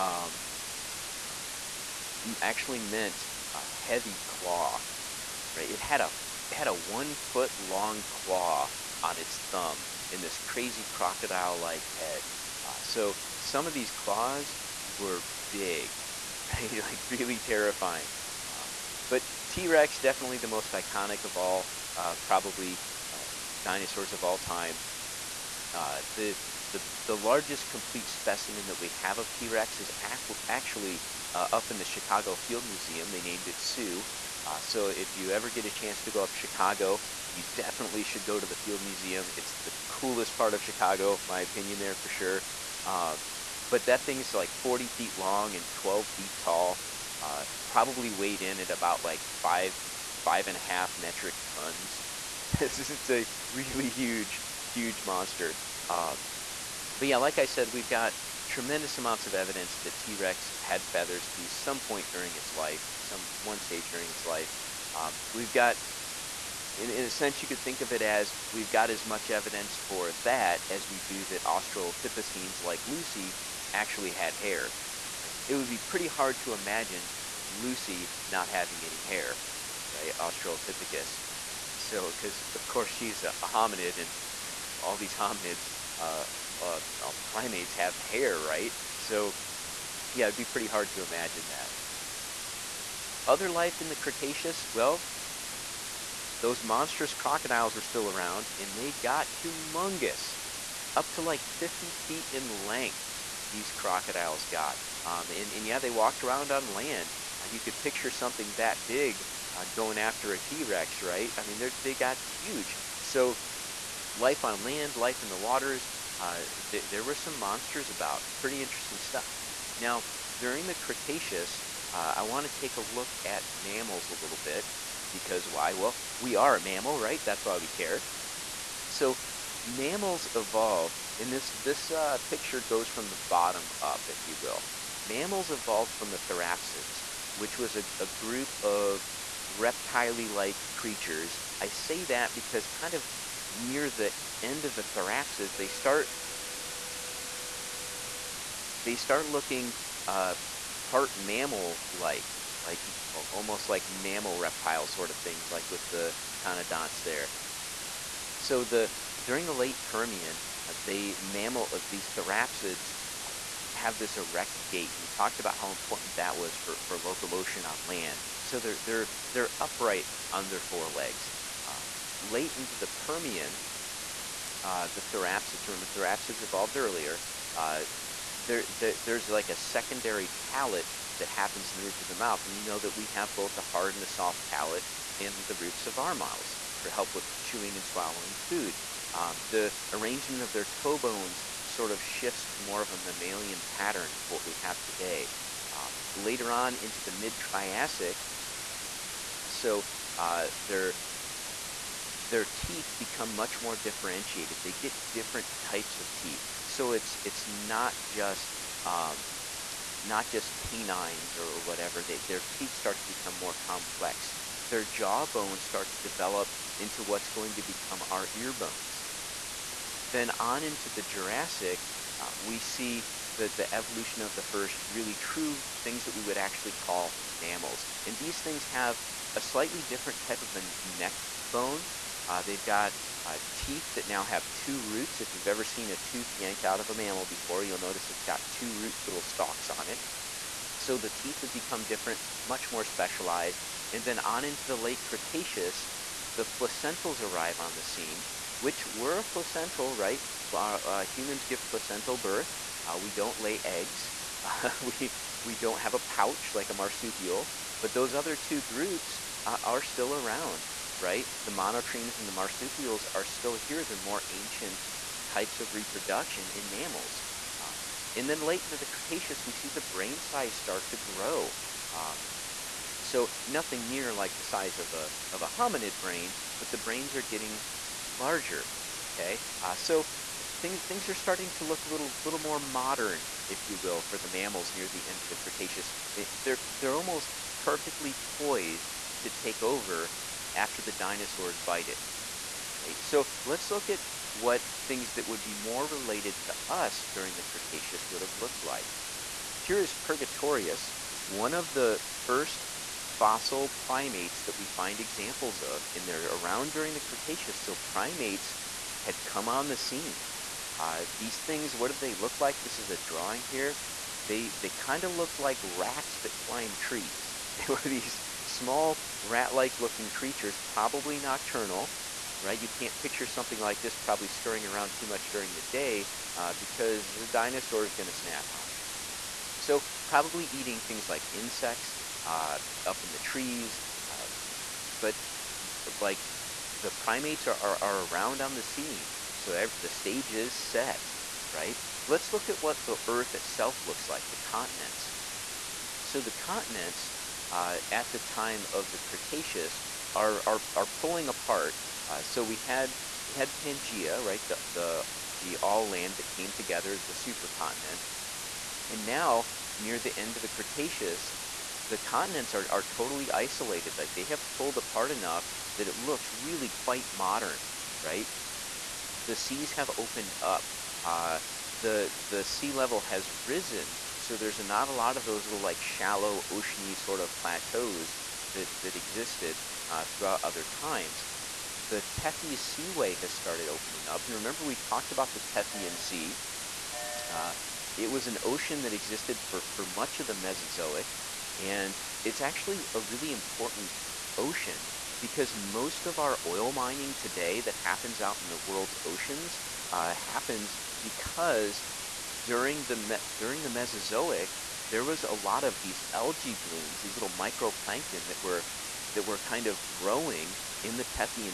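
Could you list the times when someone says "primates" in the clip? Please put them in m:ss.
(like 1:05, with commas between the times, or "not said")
1:27, 5:03, 5:07, 5:36.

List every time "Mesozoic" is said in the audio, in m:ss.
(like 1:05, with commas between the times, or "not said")
6:30, 6:43.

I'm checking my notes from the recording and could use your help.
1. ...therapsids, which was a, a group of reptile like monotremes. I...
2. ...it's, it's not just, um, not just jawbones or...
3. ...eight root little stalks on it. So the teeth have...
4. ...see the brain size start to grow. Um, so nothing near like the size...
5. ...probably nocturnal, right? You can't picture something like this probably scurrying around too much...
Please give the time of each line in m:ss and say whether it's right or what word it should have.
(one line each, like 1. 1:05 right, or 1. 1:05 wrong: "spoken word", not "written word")
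1. 2:16 wrong: "creatures", not "monotremes"
2. 3:26 wrong: "canines", not "jawbones"
3. 3:58 wrong: "two", not "eight"
4. 4:29 right
5. 5:20 right.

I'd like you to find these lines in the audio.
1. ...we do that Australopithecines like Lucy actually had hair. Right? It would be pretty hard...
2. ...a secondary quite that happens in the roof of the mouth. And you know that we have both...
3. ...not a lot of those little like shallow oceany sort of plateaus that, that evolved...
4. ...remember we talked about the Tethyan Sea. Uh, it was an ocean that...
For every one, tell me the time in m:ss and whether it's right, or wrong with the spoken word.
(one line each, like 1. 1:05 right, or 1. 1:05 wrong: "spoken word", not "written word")
1. 1:10 right
2. 2:59 wrong: "palate", not "quite"
3. 6:14 wrong: "existed", not "evolved"
4. 6:24 right.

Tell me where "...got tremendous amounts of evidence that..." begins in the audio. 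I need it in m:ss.
0:57.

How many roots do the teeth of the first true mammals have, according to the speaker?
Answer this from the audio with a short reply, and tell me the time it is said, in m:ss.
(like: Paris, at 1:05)
2, at 3:54.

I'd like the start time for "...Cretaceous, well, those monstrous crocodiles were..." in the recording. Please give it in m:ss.
1:33.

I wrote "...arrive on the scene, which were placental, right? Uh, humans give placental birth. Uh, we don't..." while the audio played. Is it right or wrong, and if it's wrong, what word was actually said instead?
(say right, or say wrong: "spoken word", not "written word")
right.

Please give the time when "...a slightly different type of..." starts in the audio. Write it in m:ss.
3:49.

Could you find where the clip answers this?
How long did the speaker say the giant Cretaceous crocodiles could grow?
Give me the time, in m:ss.
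1:41.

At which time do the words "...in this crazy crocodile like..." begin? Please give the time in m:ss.
0:10.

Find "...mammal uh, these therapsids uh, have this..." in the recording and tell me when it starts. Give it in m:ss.
2:41.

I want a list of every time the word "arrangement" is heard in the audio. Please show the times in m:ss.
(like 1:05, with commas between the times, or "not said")
3:09.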